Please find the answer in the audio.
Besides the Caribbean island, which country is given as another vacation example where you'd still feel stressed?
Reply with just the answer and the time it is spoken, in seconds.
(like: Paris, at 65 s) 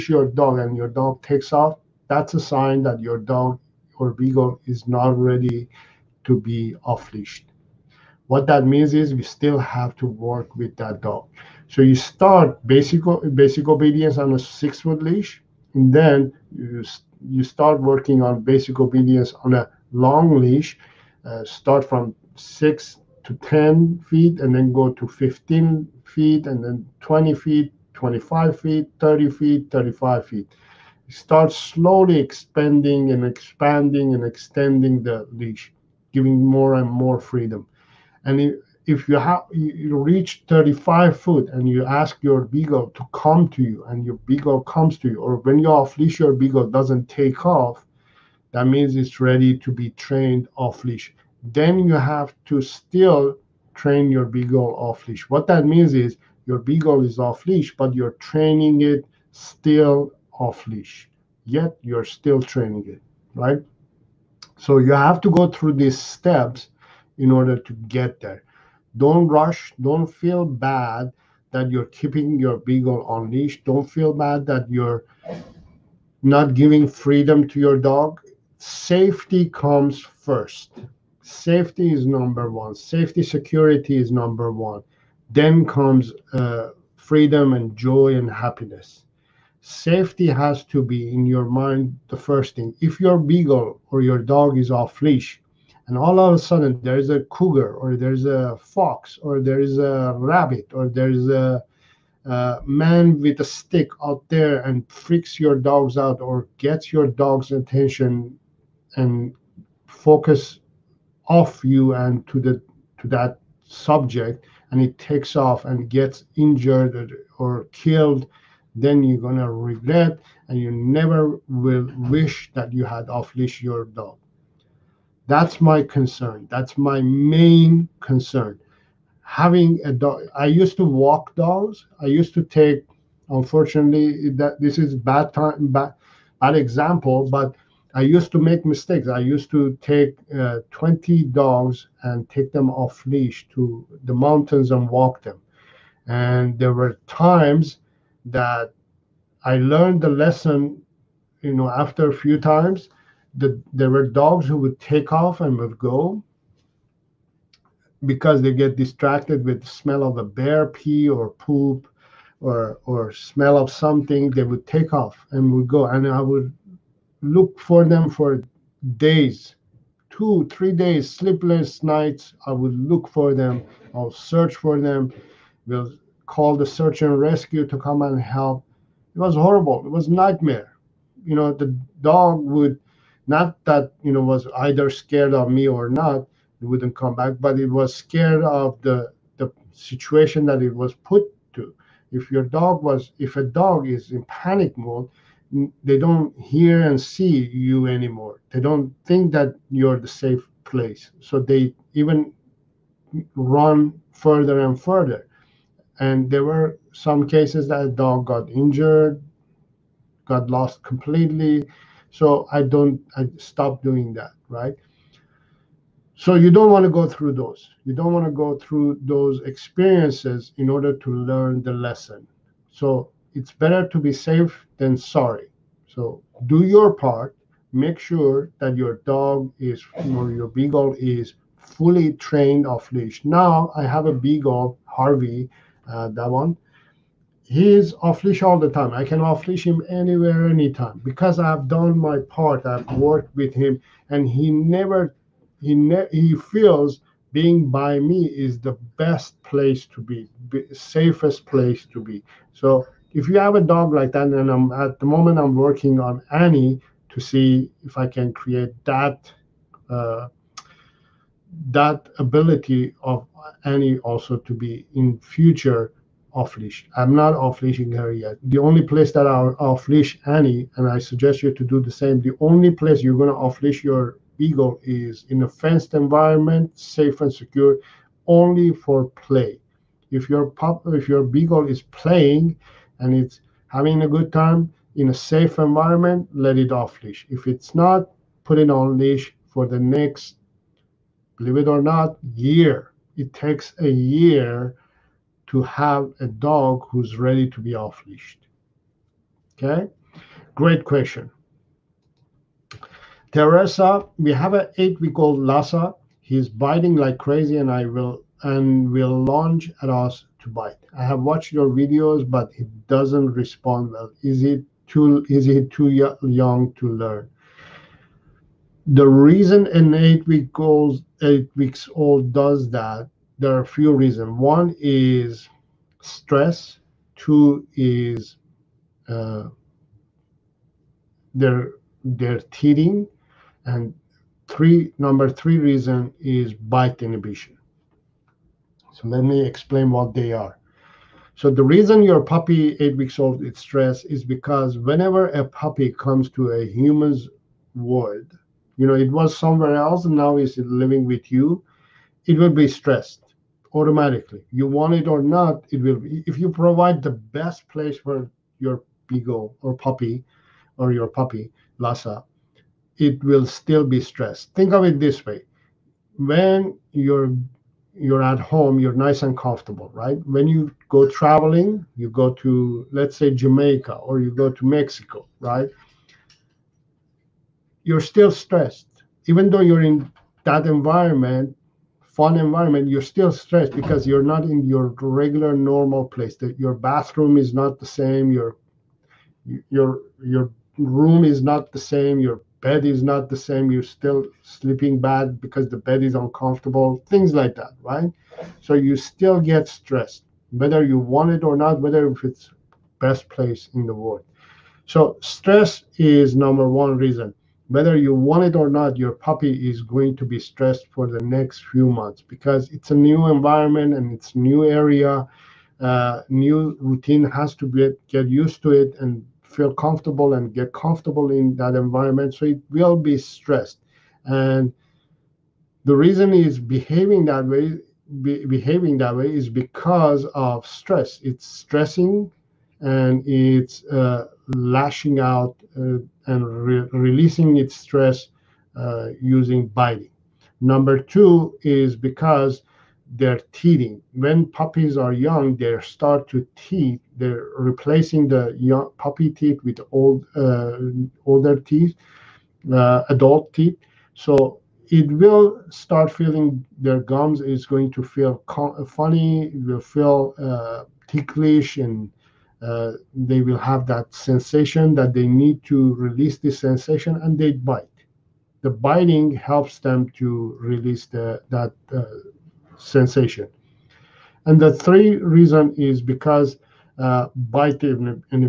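Mexico, at 374 s.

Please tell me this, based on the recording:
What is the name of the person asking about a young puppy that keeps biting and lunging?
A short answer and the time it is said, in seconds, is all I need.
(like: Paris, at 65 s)
Teresa, at 303 s.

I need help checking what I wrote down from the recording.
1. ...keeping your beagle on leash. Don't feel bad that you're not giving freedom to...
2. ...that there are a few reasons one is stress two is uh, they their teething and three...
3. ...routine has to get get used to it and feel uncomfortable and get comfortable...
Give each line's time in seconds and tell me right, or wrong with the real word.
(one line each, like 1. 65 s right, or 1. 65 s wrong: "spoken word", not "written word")
1. 71 s right
2. 322 s right
3. 416 s wrong: "comfortable", not "uncomfortable".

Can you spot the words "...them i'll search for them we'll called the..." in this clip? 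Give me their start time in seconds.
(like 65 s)
173 s.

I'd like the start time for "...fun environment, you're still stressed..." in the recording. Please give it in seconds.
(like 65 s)
382 s.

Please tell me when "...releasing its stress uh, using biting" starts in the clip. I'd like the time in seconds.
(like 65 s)
436 s.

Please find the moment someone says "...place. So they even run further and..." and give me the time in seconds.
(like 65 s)
200 s.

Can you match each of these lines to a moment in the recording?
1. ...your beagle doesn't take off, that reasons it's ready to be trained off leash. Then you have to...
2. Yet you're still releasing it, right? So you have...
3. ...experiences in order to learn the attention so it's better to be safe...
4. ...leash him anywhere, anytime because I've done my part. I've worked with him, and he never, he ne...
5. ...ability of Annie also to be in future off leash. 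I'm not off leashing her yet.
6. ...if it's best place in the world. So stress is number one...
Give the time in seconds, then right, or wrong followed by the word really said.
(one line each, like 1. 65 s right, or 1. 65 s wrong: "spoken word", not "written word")
1. 46 s wrong: "means", not "reasons"
2. 61 s wrong: "training", not "releasing"
3. 219 s wrong: "lesson", not "attention"
4. 239 s right
5. 262 s right
6. 402 s right.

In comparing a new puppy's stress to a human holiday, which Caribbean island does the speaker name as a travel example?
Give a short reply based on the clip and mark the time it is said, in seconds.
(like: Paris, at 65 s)
Jamaica, at 373 s.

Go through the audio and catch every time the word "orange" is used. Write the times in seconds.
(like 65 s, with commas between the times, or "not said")
not said.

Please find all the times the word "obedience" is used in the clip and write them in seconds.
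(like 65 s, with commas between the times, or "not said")
13 s, 18 s.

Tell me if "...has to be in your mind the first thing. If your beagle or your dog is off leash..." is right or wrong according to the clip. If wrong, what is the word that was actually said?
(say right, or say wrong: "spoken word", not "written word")
right.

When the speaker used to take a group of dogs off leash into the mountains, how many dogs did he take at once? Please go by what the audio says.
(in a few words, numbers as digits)
20.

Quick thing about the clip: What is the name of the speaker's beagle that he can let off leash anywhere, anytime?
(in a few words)
Harvey.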